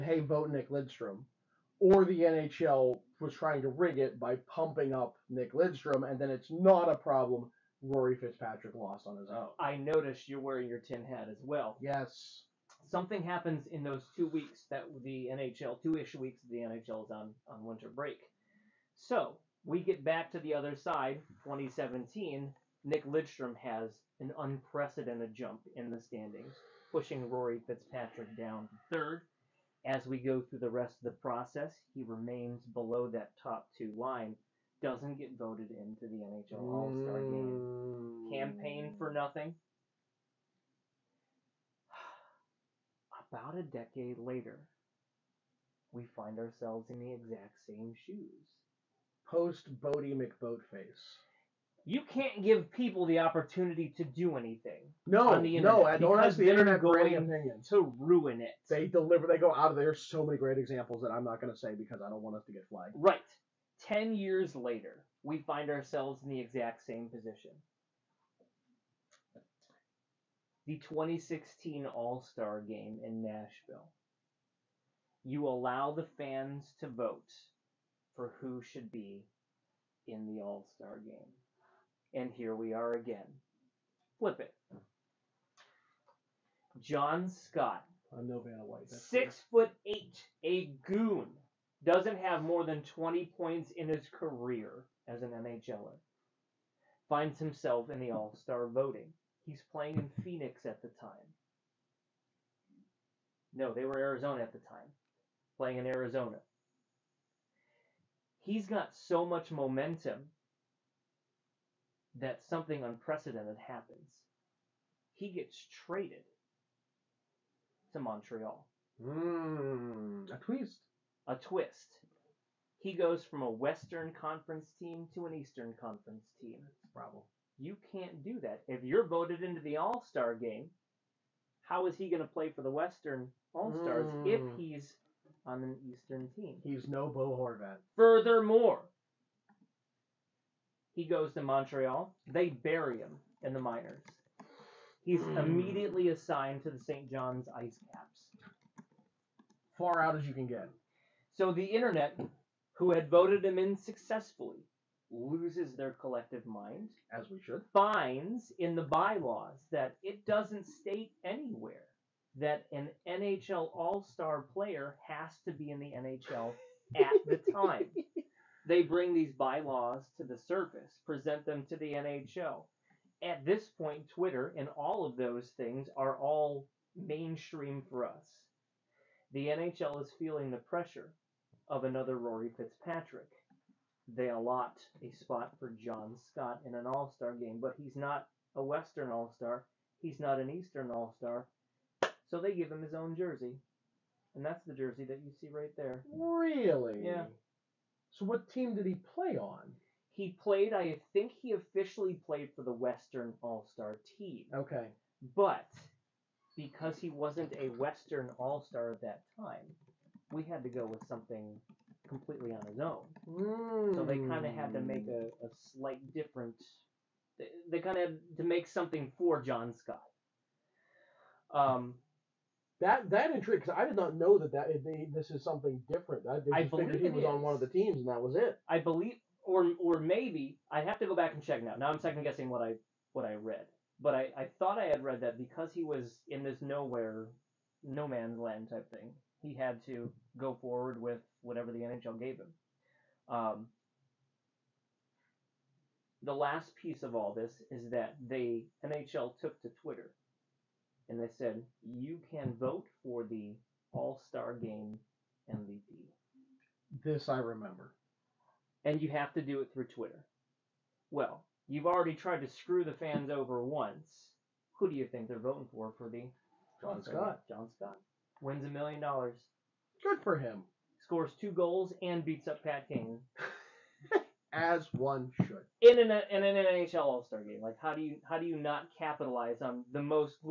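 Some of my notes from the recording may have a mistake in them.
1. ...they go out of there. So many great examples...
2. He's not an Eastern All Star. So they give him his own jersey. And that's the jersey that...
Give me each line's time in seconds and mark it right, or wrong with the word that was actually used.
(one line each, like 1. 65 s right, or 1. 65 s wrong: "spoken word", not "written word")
1. 59 s right
2. 190 s right.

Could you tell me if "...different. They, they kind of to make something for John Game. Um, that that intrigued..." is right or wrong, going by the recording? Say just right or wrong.
wrong.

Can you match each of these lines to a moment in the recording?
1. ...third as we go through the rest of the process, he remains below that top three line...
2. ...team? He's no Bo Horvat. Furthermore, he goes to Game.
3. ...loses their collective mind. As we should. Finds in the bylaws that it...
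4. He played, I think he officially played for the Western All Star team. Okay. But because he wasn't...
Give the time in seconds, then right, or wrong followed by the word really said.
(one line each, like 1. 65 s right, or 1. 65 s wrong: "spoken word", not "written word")
1. 28 s wrong: "two", not "three"
2. 136 s wrong: "Montreal", not "Game"
3. 155 s right
4. 200 s right.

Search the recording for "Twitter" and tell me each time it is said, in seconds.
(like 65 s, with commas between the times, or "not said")
174 s, 249 s, 259 s.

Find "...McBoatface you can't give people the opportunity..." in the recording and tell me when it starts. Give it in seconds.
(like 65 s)
50 s.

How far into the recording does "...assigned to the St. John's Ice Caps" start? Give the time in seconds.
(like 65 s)
146 s.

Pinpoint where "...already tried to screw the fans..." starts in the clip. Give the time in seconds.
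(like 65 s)
261 s.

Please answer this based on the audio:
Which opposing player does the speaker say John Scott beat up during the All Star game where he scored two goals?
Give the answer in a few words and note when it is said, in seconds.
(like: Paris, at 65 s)
Pat Kane, at 272 s.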